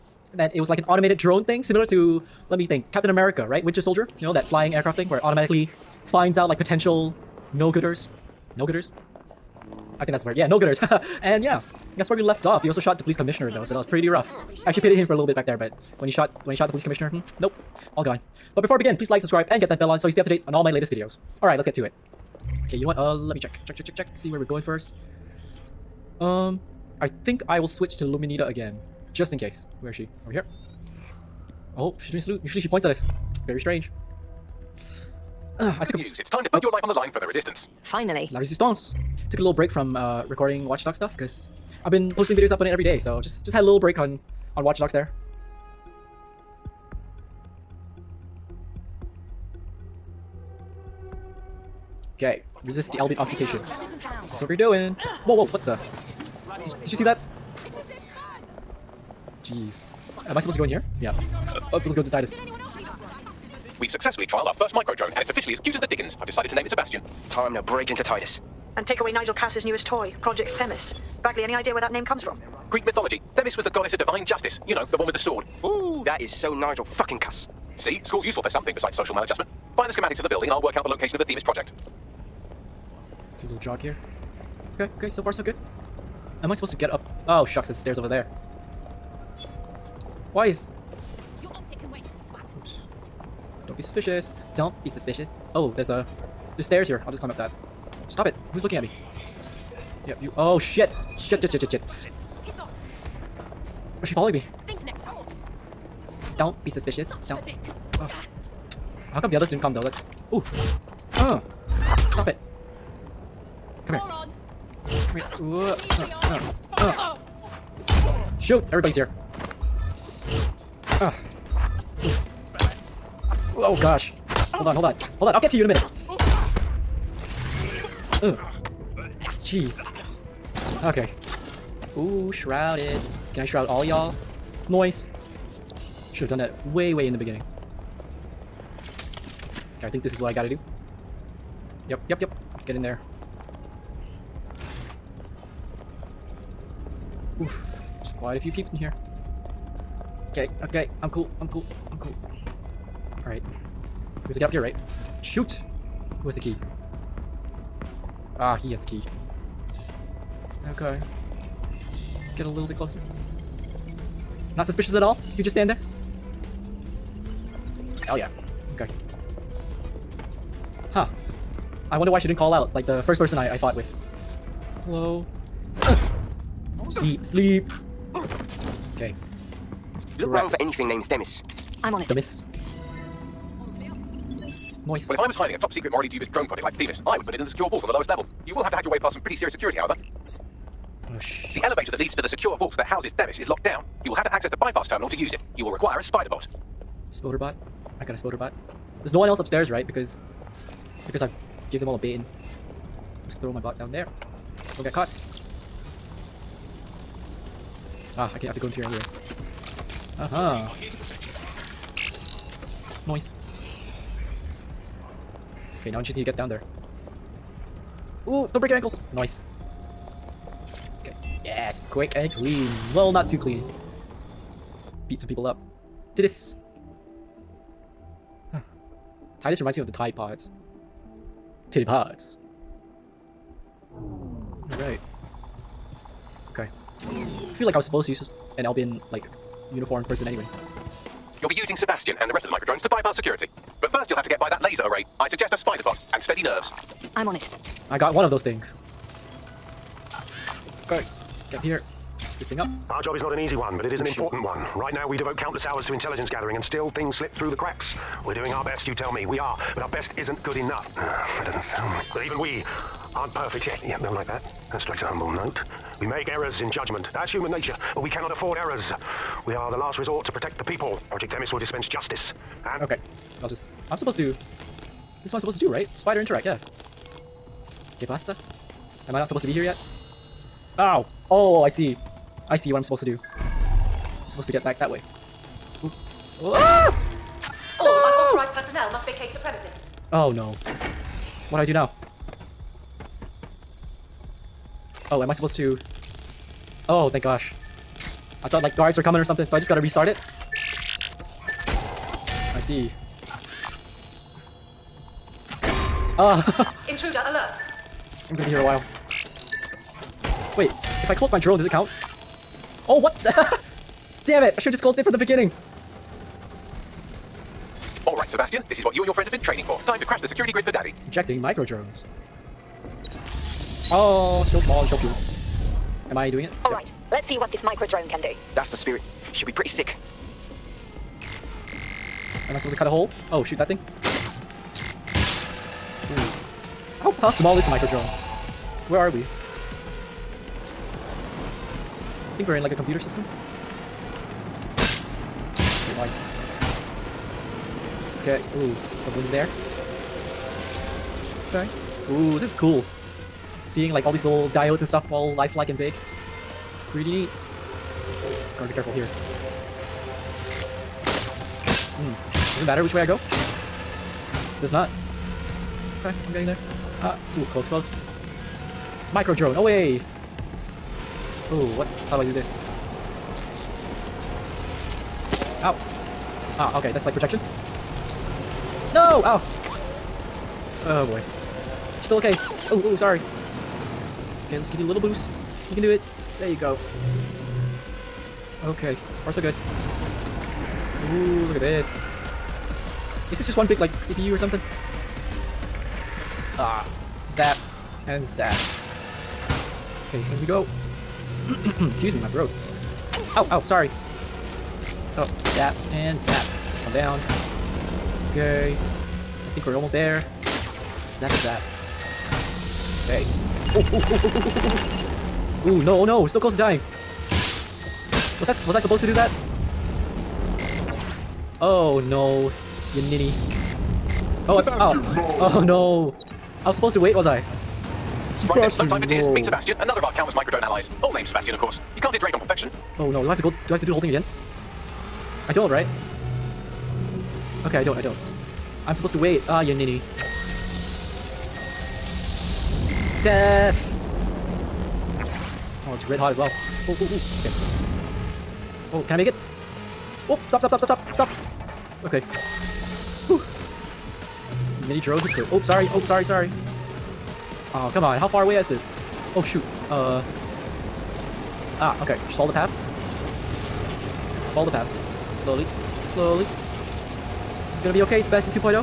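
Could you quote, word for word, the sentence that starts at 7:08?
Right then, no time for tears.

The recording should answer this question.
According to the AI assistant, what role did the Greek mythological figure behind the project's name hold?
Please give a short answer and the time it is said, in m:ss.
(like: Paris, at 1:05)
Goddess of divine justice, at 1:13.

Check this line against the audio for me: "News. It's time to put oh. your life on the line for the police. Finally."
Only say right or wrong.
wrong.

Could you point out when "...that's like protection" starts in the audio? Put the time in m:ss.
6:16.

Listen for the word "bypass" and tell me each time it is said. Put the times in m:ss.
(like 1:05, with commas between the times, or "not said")
3:14, 4:02.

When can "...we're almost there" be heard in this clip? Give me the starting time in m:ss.
6:49.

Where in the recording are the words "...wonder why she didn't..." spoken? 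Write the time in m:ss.
2:51.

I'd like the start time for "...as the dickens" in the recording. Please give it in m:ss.
1:05.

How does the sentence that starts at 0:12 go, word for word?
He also shot the police commissioner though, so that was pretty rough.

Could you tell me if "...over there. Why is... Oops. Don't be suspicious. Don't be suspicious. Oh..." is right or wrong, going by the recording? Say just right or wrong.
right.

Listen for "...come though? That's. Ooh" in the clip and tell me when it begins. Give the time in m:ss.
1:49.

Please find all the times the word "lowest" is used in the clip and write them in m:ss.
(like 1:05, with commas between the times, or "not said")
3:07.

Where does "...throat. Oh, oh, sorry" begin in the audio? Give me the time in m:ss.
6:42.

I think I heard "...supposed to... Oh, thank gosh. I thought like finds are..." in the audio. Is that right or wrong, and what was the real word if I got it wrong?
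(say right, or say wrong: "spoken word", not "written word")
wrong: "guards", not "finds".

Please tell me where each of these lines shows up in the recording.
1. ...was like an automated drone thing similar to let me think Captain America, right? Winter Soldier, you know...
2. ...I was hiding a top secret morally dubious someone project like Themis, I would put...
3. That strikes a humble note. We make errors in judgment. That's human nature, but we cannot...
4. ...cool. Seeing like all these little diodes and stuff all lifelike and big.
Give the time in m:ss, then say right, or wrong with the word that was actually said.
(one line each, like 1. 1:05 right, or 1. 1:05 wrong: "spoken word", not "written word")
1. 0:00 right
2. 3:05 wrong: "drone", not "someone"
3. 4:24 right
4. 5:52 right.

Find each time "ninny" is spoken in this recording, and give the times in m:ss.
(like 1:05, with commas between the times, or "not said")
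7:03, 7:19.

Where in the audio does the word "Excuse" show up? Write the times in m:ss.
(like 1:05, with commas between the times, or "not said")
6:41.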